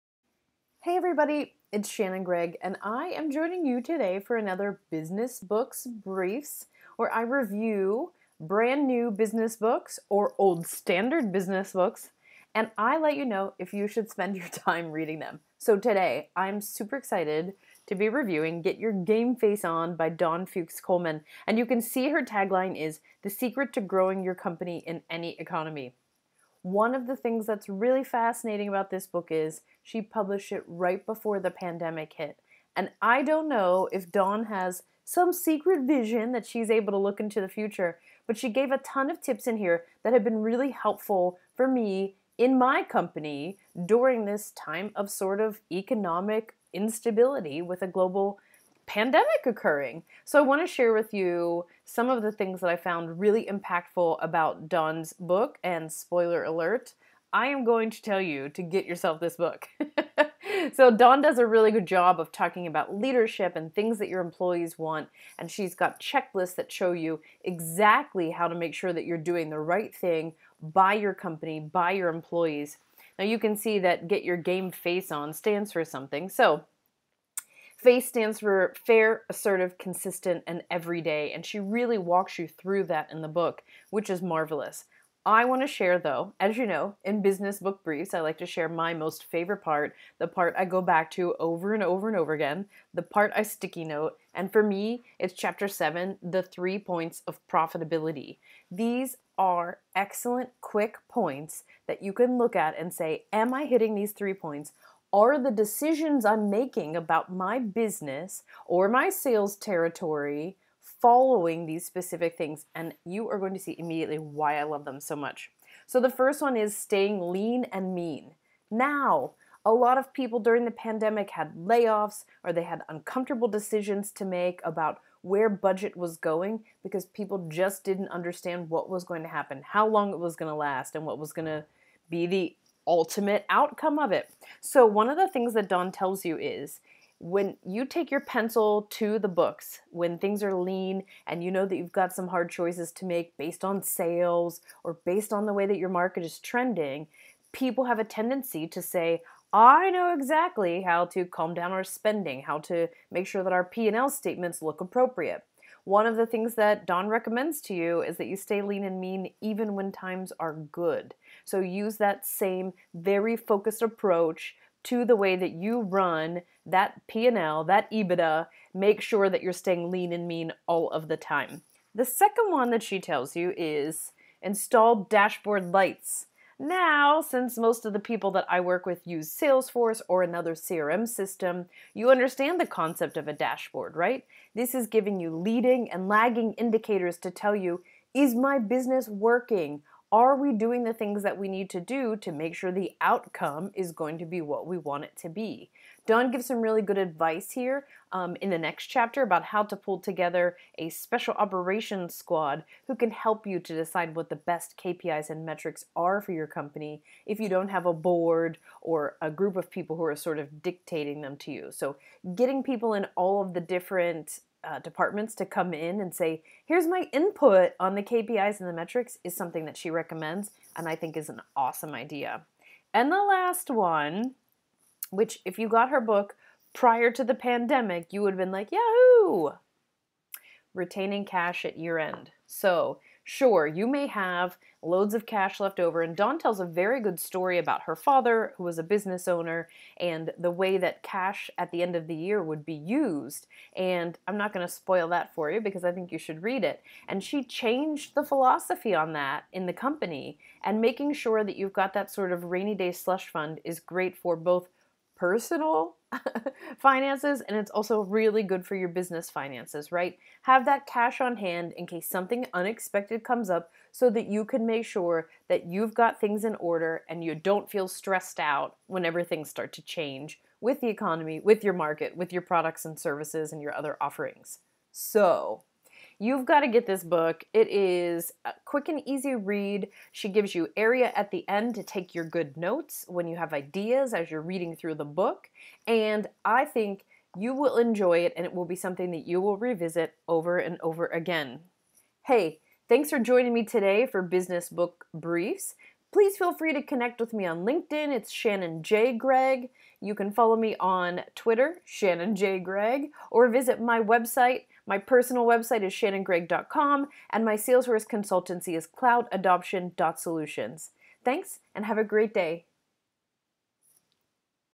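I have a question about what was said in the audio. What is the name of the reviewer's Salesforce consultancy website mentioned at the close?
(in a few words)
cloudadoption.solutions.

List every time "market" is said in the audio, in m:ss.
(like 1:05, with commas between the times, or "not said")
2:25, 4:31.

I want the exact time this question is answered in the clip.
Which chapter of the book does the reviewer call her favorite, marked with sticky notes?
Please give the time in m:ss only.
1:35.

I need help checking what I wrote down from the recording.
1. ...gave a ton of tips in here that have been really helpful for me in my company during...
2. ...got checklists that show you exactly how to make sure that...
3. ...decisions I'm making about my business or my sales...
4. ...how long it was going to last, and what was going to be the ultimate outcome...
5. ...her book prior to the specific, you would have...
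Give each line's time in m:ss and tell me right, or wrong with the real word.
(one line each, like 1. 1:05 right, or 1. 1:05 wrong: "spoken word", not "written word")
1. 0:38 right
2. 1:05 right
3. 1:45 right
4. 2:09 right
5. 3:45 wrong: "pandemic", not "specific".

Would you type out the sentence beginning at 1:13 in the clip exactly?
Now you can see that get your game face on stands for something.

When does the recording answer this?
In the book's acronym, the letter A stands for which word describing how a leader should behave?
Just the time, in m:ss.
1:19.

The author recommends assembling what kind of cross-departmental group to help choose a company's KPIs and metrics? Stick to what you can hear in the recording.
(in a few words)
Special operations squad.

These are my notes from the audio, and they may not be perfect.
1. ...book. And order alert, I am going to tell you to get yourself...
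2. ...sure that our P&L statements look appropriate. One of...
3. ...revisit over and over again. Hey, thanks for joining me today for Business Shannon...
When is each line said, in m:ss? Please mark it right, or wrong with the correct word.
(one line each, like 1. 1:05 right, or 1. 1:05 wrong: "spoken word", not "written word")
1. 0:55 wrong: "spoiler", not "order"
2. 2:33 right
3. 4:49 wrong: "Book", not "Shannon".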